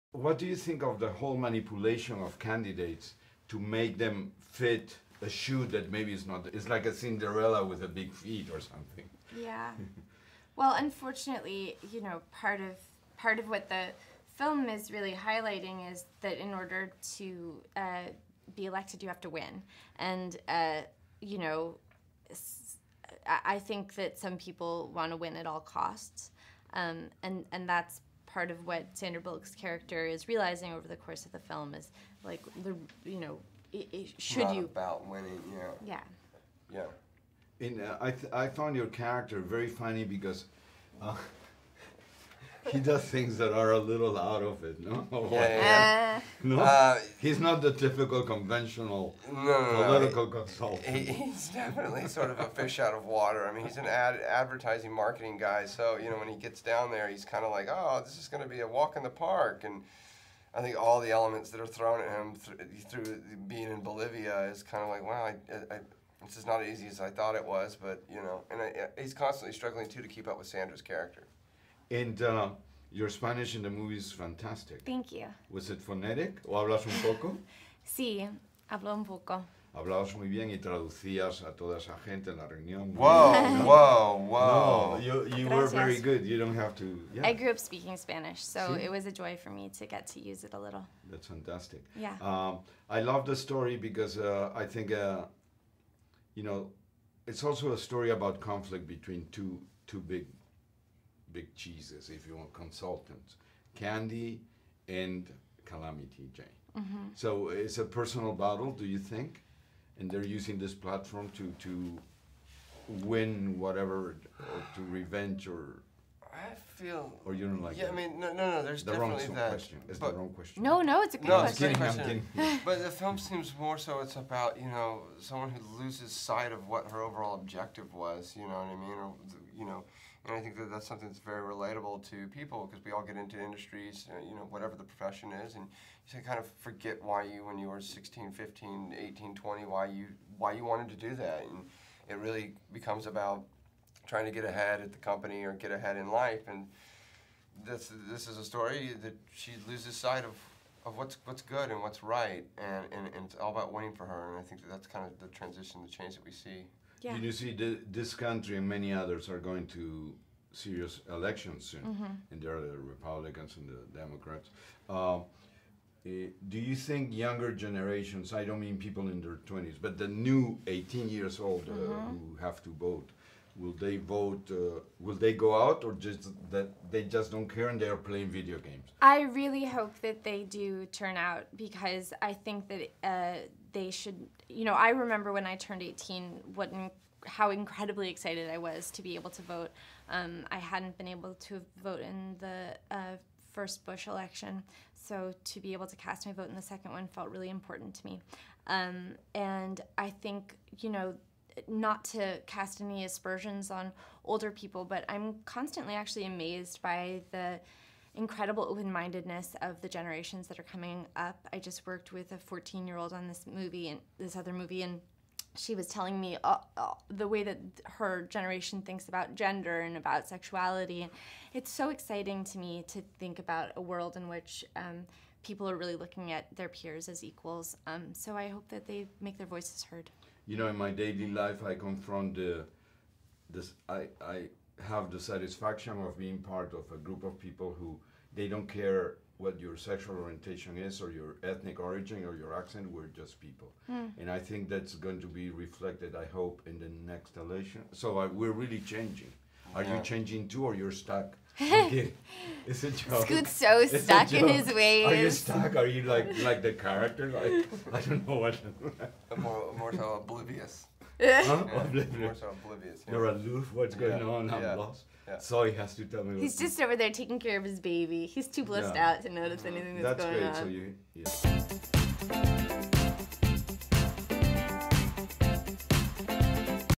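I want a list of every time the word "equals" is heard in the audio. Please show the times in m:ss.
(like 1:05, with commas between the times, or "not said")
3:47.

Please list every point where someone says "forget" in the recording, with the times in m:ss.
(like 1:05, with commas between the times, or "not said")
2:16.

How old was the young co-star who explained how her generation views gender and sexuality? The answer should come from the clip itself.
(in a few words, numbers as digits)
14.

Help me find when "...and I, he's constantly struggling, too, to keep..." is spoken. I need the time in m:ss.
1:08.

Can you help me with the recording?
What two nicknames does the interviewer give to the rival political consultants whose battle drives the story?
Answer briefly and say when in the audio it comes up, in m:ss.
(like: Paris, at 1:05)
Candy and Calamity Jane, at 1:43.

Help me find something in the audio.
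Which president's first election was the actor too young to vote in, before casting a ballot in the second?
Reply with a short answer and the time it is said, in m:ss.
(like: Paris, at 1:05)
Bush, at 3:13.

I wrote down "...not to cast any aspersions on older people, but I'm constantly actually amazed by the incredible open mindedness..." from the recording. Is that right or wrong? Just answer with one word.
right.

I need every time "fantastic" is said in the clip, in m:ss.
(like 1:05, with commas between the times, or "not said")
1:14, 1:31.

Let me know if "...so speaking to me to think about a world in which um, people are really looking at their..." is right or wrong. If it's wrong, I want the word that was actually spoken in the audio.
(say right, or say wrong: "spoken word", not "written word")
wrong: "exciting", not "speaking".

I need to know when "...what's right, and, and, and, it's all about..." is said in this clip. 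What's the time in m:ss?
2:31.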